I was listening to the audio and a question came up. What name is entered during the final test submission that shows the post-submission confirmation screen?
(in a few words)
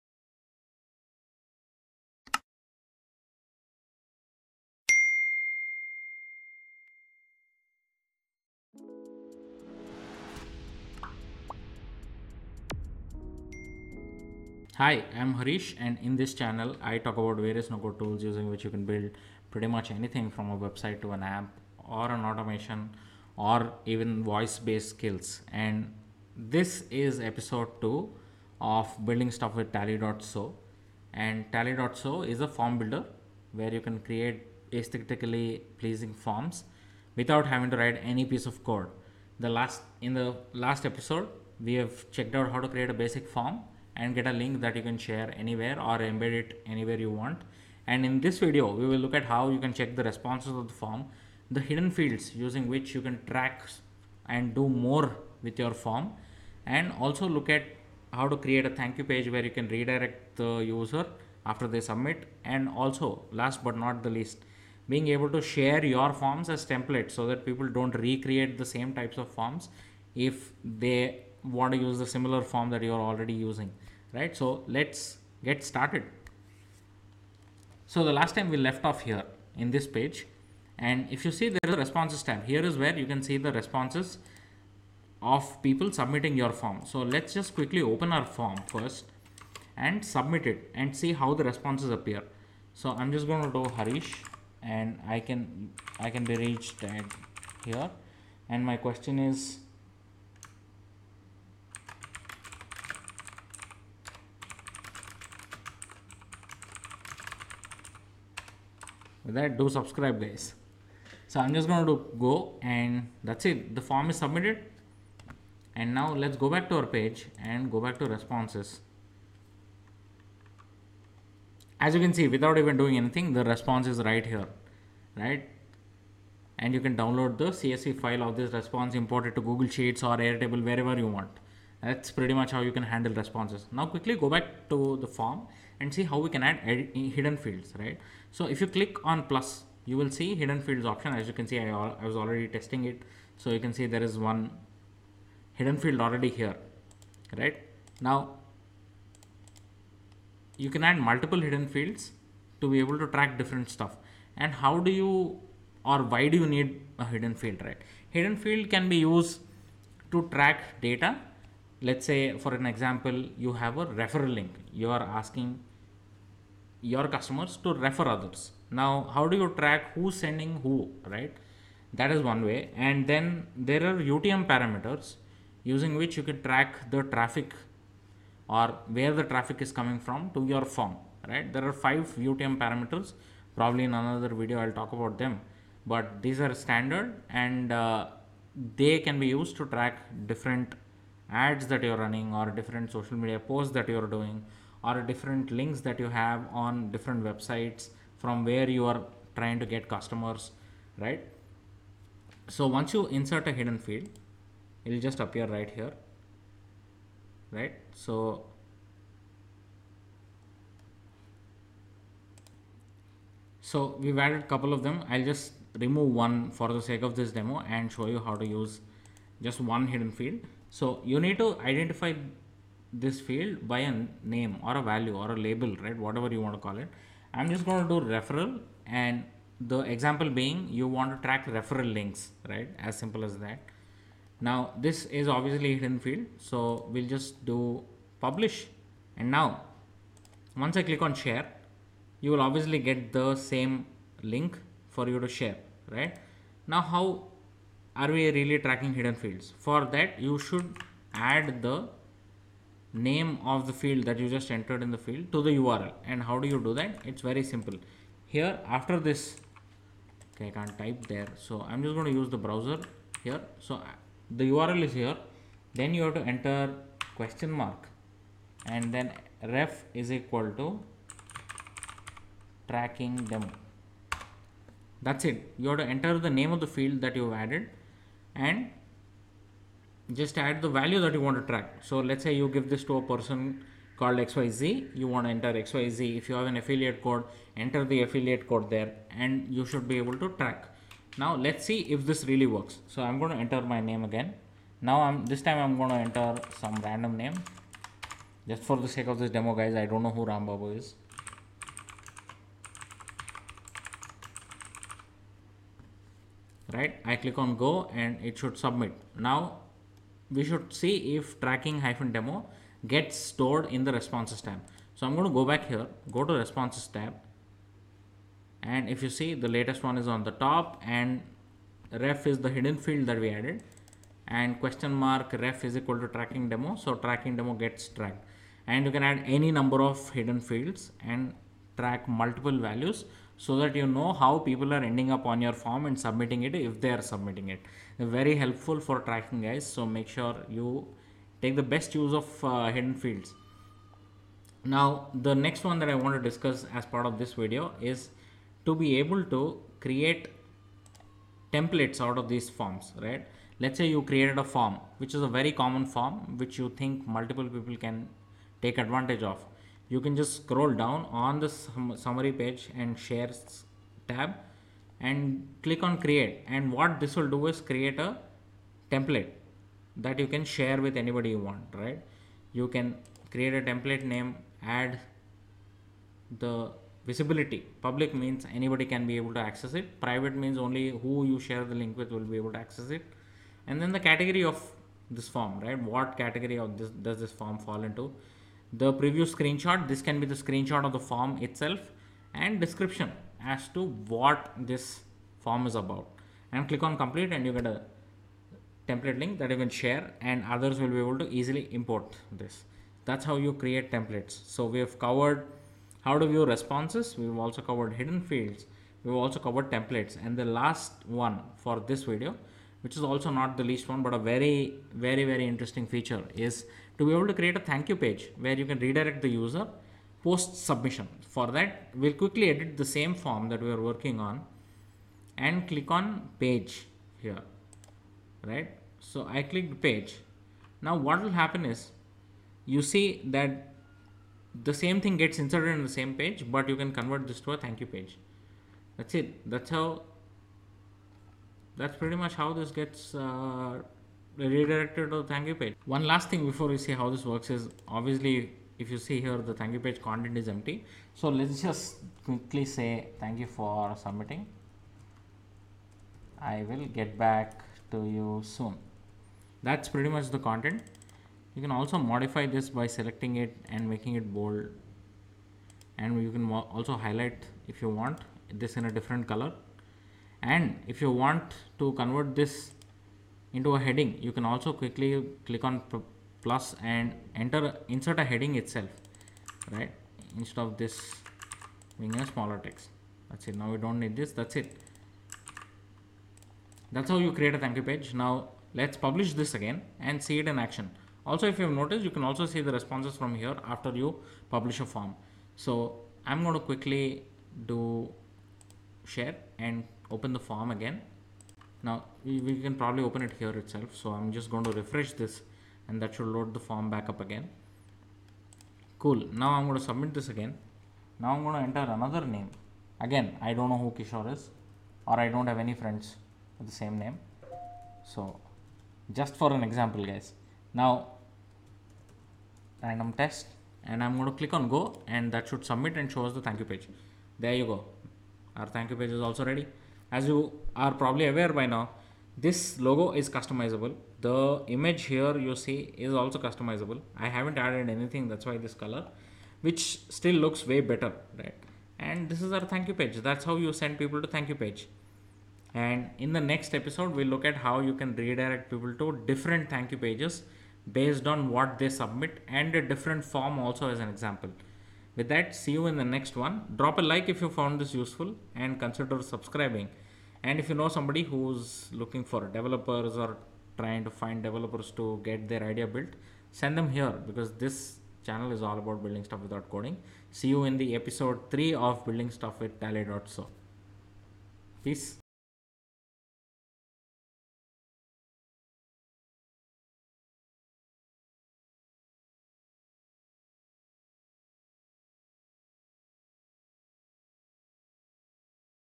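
Kishore.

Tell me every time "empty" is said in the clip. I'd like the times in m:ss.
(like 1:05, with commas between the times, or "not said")
7:30.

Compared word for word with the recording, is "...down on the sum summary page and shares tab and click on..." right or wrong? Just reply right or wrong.
right.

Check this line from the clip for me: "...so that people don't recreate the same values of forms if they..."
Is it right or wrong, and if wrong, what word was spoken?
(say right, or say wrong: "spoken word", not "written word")
wrong: "types", not "values".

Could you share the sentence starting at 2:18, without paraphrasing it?
So if you click on plus, you will see hidden fields option.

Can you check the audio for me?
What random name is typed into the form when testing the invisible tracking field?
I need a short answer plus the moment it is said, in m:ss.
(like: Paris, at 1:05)
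Ram Babu, at 5:00.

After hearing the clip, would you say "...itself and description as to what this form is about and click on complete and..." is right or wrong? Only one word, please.
right.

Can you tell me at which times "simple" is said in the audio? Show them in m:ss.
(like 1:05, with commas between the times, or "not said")
3:52, 4:17.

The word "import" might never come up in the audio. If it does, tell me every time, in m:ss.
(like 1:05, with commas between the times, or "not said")
2:08, 6:41.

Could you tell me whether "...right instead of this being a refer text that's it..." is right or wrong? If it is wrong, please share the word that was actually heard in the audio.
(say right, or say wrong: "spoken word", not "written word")
wrong: "smaller", not "refer".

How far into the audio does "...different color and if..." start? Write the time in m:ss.
7:48.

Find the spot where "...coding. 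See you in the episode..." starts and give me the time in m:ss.
9:29.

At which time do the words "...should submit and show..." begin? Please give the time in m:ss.
8:45.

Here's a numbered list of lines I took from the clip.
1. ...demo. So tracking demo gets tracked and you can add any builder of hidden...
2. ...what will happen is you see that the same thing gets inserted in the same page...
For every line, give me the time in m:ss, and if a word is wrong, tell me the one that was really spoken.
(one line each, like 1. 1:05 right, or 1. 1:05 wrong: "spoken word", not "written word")
1. 5:26 wrong: "number", not "builder"
2. 7:11 right.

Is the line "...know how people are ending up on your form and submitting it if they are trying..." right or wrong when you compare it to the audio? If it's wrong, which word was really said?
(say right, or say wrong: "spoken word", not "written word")
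wrong: "submitting", not "trying".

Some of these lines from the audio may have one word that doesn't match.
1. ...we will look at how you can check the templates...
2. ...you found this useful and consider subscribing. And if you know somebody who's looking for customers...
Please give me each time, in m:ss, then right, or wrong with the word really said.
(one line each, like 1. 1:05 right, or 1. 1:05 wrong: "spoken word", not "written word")
1. 0:48 wrong: "responses", not "templates"
2. 9:17 wrong: "developers", not "customers".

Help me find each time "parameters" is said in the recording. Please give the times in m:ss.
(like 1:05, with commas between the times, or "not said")
2:54, 3:02.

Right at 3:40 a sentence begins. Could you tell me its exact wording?
So you need to identify this field by a name or a value or a label, right?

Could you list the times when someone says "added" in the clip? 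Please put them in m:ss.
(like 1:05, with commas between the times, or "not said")
3:34, 4:37, 5:23, 8:57.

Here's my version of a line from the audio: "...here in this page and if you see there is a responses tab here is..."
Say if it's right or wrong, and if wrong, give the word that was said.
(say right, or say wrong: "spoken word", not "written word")
right.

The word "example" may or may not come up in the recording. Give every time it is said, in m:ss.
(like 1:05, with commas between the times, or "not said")
2:42, 3:49, 8:39, 9:14.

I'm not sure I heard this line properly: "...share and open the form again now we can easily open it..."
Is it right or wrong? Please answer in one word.
wrong.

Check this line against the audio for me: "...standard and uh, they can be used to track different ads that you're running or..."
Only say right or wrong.
right.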